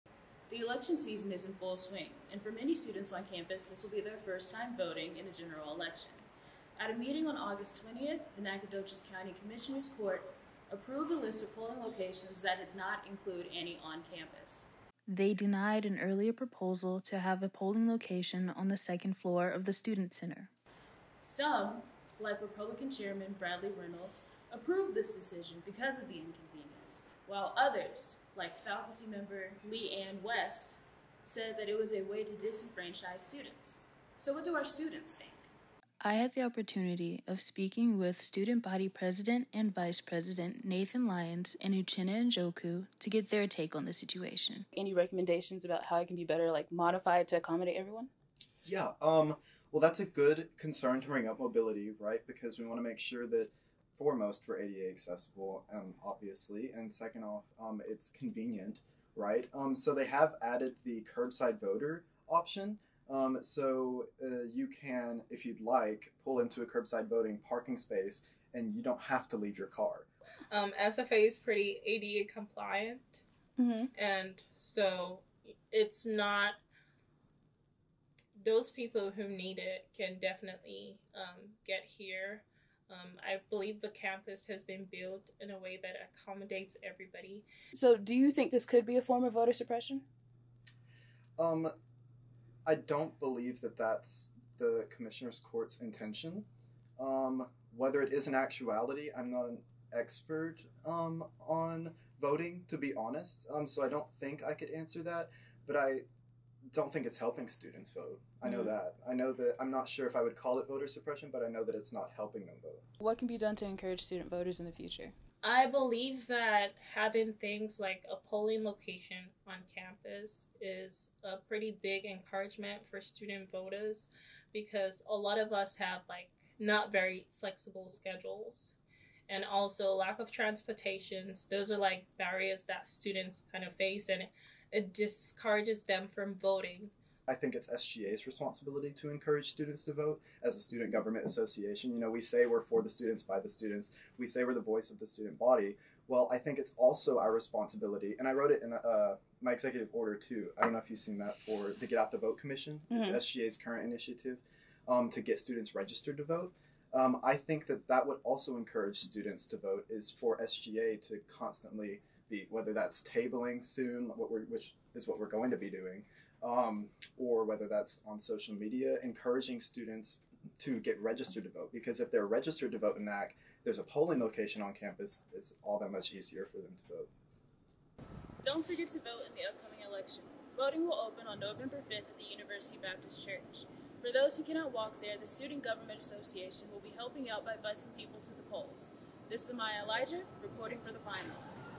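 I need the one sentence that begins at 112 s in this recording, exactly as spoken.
What can be done to encourage student voters in the future?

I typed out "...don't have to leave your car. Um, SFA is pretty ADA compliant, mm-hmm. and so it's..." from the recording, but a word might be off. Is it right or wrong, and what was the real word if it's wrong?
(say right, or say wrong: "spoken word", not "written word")
right.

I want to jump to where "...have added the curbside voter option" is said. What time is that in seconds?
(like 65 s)
60 s.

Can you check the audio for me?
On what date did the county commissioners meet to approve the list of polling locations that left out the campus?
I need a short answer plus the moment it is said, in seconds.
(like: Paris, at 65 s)
August 20th, at 7 s.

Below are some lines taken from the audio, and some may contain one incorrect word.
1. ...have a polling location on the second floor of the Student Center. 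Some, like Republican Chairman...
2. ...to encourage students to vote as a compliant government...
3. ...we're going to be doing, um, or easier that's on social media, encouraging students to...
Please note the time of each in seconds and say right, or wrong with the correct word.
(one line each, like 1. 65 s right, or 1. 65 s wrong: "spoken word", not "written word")
1. 17 s right
2. 139 s wrong: "student", not "compliant"
3. 165 s wrong: "whether", not "easier".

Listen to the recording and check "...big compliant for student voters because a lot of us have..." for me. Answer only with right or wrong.
wrong.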